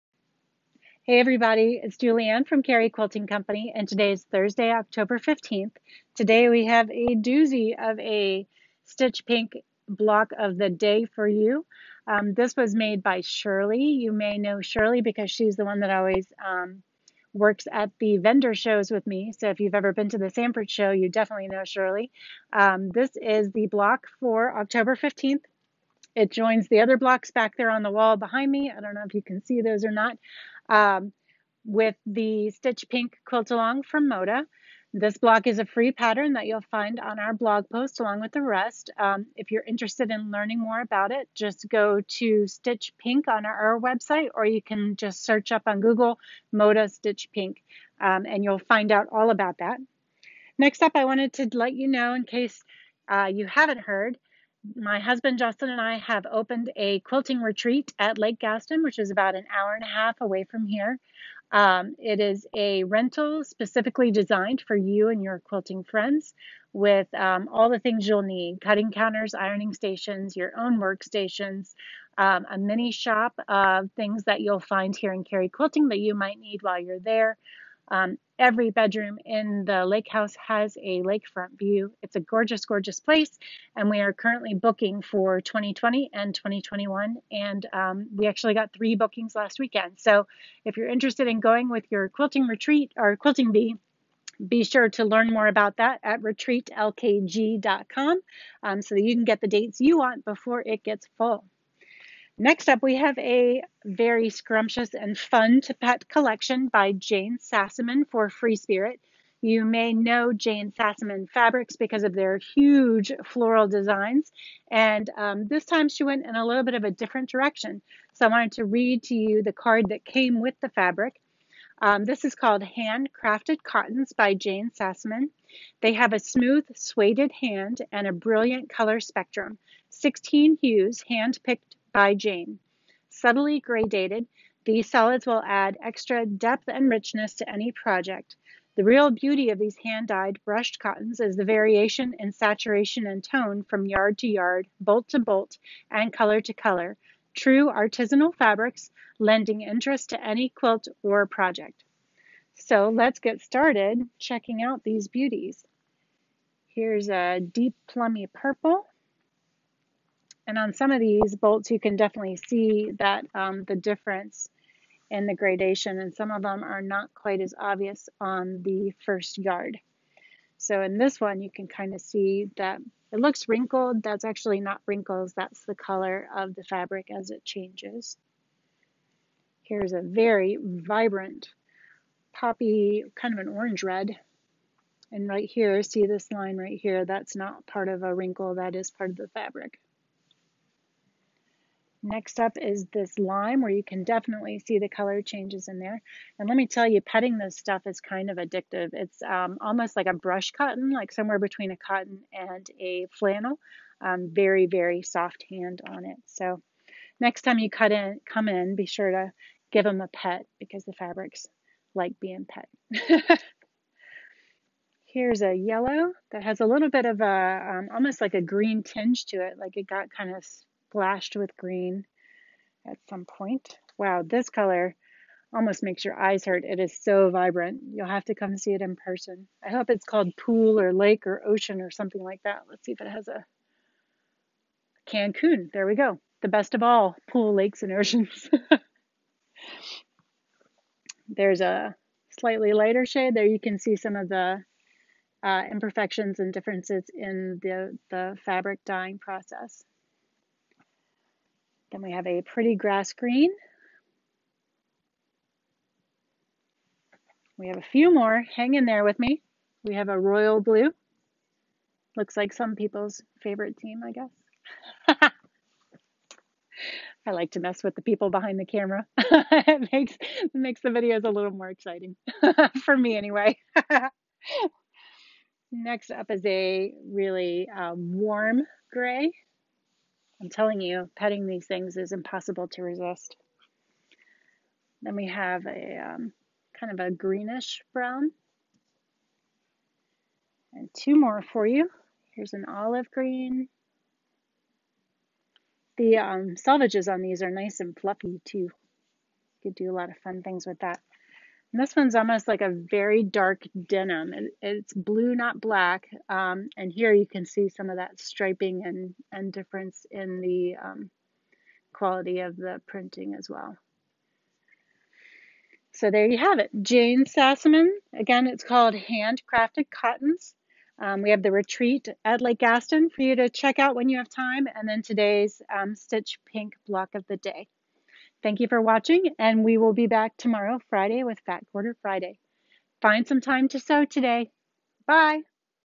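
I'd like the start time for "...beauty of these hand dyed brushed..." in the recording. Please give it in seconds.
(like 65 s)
139 s.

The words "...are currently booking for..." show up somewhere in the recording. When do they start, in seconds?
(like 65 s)
84 s.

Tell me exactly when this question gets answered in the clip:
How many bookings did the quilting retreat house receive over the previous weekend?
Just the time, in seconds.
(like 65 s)
88 s.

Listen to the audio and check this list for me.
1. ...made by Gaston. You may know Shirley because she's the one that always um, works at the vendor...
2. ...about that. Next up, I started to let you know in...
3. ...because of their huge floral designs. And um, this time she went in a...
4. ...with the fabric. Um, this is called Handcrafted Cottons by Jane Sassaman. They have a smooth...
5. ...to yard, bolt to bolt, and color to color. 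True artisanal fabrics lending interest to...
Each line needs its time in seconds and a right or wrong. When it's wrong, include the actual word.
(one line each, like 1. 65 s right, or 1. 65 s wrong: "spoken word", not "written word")
1. 12 s wrong: "Shirley", not "Gaston"
2. 49 s wrong: "wanted", not "started"
3. 111 s right
4. 120 s right
5. 144 s right.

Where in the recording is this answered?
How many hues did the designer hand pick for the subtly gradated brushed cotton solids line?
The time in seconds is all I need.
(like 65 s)
129 s.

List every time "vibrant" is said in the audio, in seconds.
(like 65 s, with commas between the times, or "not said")
180 s, 227 s.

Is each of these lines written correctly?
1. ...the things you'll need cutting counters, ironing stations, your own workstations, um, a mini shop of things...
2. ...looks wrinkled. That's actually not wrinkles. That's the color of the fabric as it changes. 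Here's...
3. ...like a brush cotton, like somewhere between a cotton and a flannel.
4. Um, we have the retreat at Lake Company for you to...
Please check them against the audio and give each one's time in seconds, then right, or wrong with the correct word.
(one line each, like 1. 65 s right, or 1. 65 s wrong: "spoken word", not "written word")
1. 67 s right
2. 173 s right
3. 199 s right
4. 321 s wrong: "Gaston", not "Company".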